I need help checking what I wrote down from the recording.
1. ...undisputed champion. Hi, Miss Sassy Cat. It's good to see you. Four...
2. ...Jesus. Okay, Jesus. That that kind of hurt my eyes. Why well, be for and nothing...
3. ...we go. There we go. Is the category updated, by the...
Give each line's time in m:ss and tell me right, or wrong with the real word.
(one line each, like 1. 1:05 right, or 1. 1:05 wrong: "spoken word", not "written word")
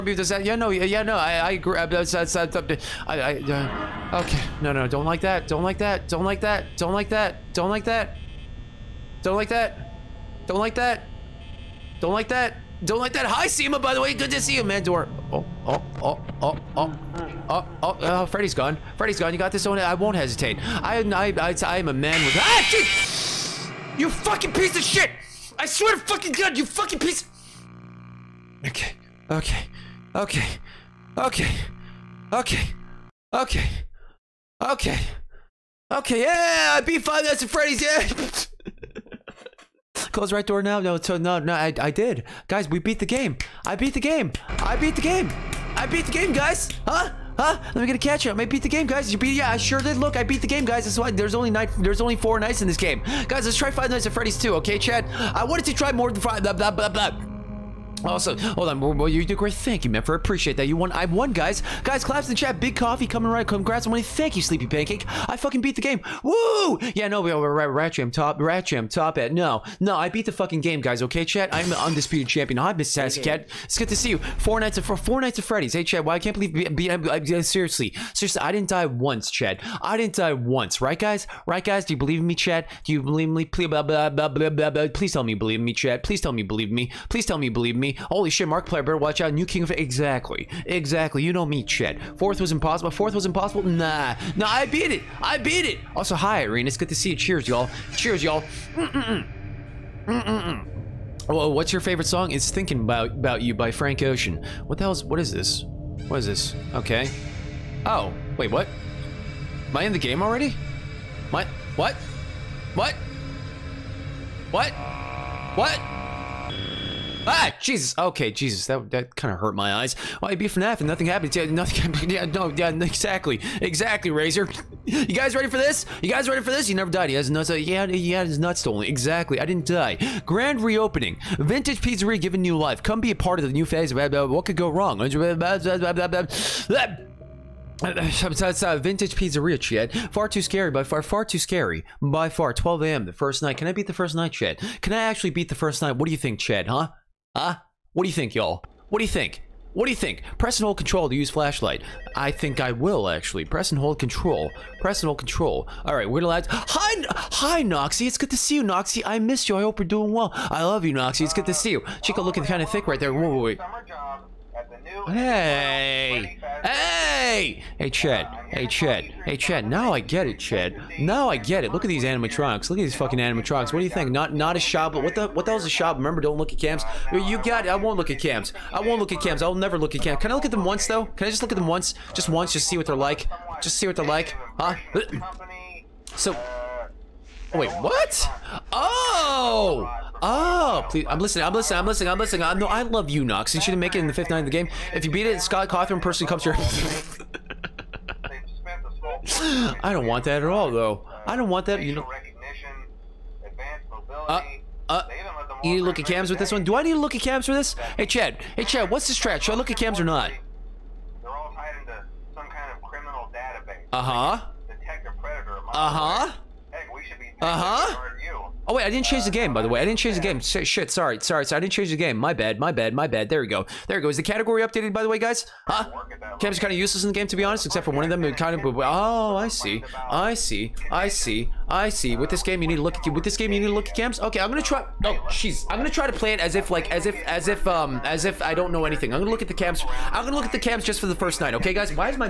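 1. 1:11 right
2. 1:57 right
3. 3:43 right.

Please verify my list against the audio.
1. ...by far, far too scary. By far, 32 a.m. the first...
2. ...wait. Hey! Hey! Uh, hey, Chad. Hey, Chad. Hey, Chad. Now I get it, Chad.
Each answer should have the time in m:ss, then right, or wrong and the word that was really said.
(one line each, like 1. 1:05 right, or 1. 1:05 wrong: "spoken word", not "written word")
1. 2:20 wrong: "12", not "32"
2. 2:43 right.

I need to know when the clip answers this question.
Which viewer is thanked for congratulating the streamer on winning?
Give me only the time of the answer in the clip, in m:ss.
1:04.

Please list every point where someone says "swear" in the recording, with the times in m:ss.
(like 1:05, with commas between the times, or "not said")
0:25.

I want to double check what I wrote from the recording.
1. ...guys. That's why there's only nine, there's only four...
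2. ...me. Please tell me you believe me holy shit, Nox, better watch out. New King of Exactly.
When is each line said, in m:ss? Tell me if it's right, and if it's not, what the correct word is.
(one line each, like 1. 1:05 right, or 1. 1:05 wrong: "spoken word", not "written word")
1. 0:50 right
2. 1:26 wrong: "Markiplier", not "Nox".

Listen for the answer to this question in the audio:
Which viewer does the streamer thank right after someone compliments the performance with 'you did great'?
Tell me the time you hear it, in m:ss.
0:59.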